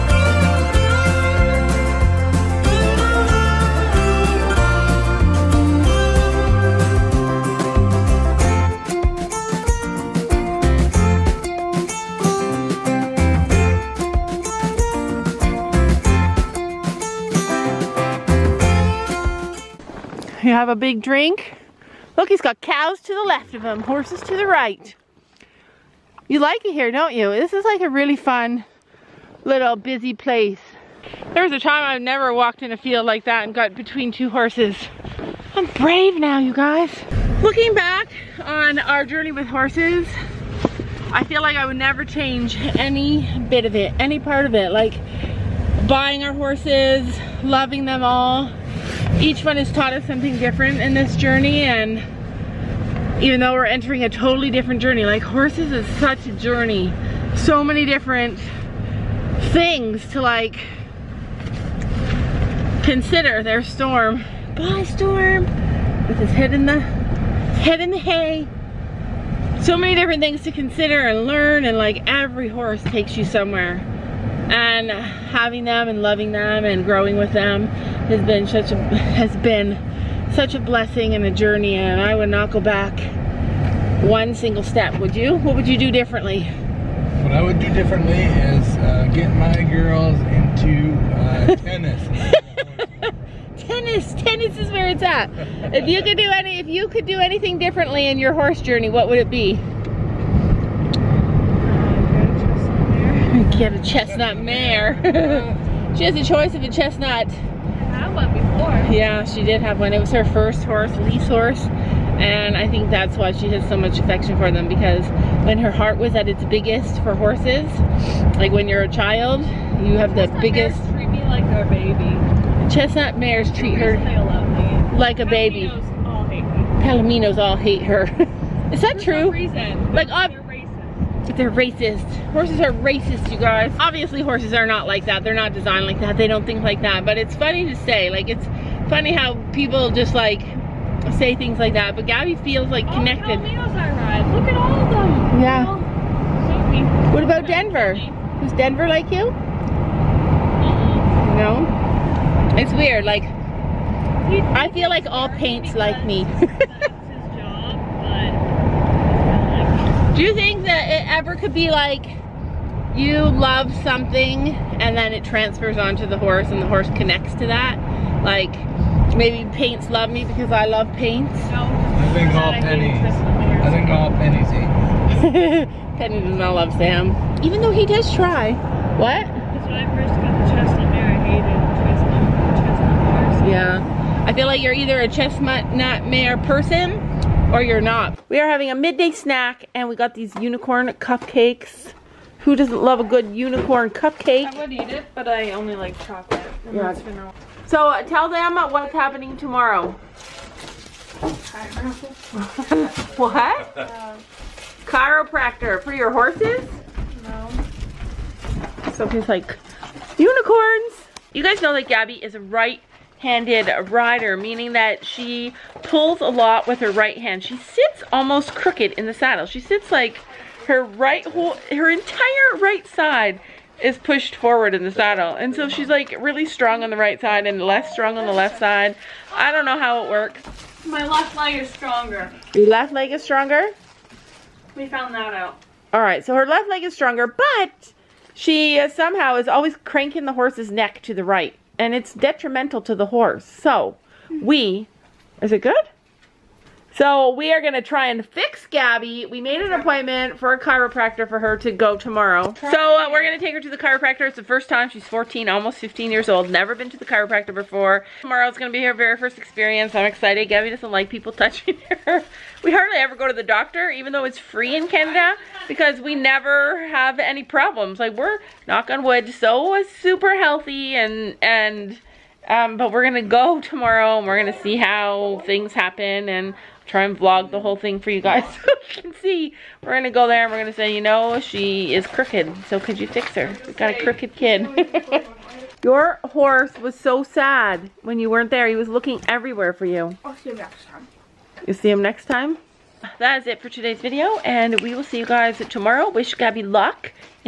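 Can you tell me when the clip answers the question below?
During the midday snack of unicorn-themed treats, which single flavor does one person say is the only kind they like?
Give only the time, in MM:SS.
03:16.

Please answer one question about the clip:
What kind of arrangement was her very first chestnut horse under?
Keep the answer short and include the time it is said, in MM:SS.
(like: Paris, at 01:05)
Lease horse, at 01:50.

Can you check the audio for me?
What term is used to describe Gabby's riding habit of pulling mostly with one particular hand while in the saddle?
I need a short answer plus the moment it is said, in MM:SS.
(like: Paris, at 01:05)
Right handed rider, at 03:32.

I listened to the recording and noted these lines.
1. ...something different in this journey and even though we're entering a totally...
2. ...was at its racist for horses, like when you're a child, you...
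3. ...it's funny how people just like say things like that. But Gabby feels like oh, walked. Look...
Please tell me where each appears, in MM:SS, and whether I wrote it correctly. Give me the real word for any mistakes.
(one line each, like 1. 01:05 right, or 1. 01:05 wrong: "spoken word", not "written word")
1. 00:50 right
2. 01:55 wrong: "biggest", not "racist"
3. 02:18 wrong: "connected", not "walked".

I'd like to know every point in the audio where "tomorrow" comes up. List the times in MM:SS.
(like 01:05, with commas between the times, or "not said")
03:19, 04:11, 04:18, 04:33, 04:55.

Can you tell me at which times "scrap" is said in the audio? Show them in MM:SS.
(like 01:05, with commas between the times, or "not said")
not said.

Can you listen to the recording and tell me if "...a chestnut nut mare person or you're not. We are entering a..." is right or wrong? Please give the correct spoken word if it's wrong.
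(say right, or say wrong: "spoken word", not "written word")
wrong: "having", not "entering".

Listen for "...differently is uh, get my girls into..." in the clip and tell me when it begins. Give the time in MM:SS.
01:27.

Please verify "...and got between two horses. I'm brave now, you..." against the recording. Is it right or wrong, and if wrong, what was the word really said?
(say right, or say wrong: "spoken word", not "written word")
right.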